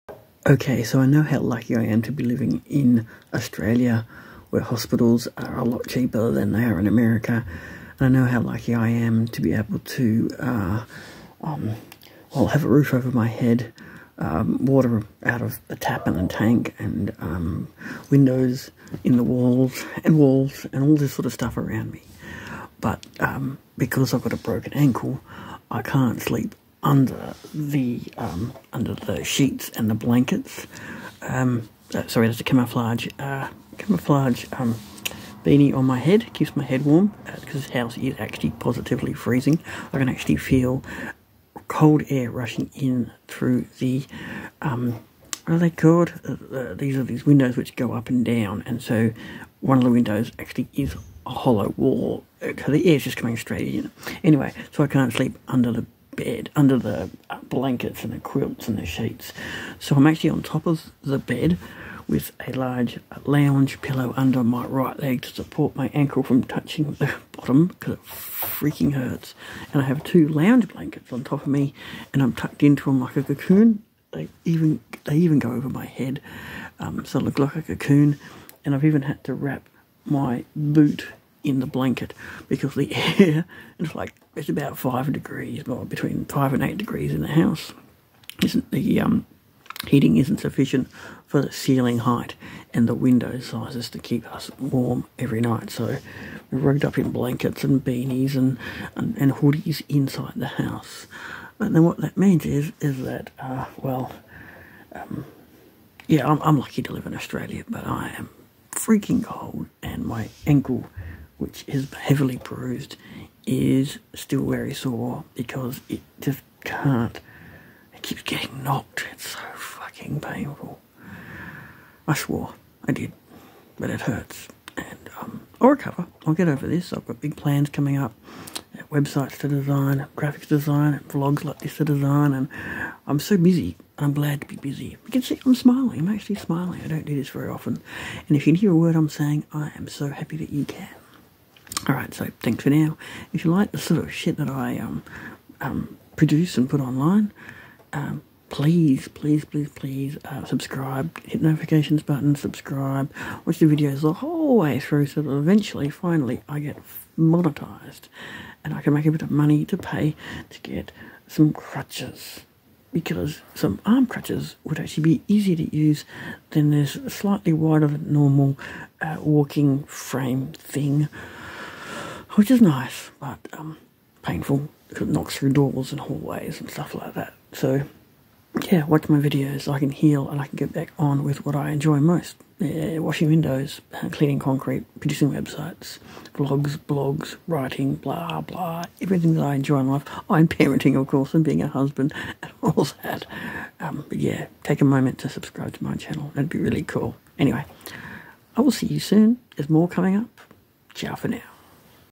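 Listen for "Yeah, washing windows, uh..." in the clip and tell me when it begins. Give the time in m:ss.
3:02.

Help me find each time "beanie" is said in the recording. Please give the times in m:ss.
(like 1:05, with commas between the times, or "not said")
0:35, 1:37.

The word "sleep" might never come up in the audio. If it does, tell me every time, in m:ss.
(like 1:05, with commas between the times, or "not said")
0:26, 0:55.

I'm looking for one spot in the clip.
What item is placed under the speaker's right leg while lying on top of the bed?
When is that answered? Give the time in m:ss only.
1:02.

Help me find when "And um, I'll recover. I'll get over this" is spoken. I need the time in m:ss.
2:04.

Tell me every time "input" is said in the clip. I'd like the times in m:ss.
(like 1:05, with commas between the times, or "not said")
not said.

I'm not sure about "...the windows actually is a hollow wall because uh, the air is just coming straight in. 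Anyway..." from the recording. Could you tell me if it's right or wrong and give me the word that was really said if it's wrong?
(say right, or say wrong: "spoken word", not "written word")
right.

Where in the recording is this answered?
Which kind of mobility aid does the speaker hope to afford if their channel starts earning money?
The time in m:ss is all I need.
2:43.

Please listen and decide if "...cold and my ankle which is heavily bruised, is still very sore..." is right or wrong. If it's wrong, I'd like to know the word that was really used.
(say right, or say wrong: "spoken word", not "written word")
right.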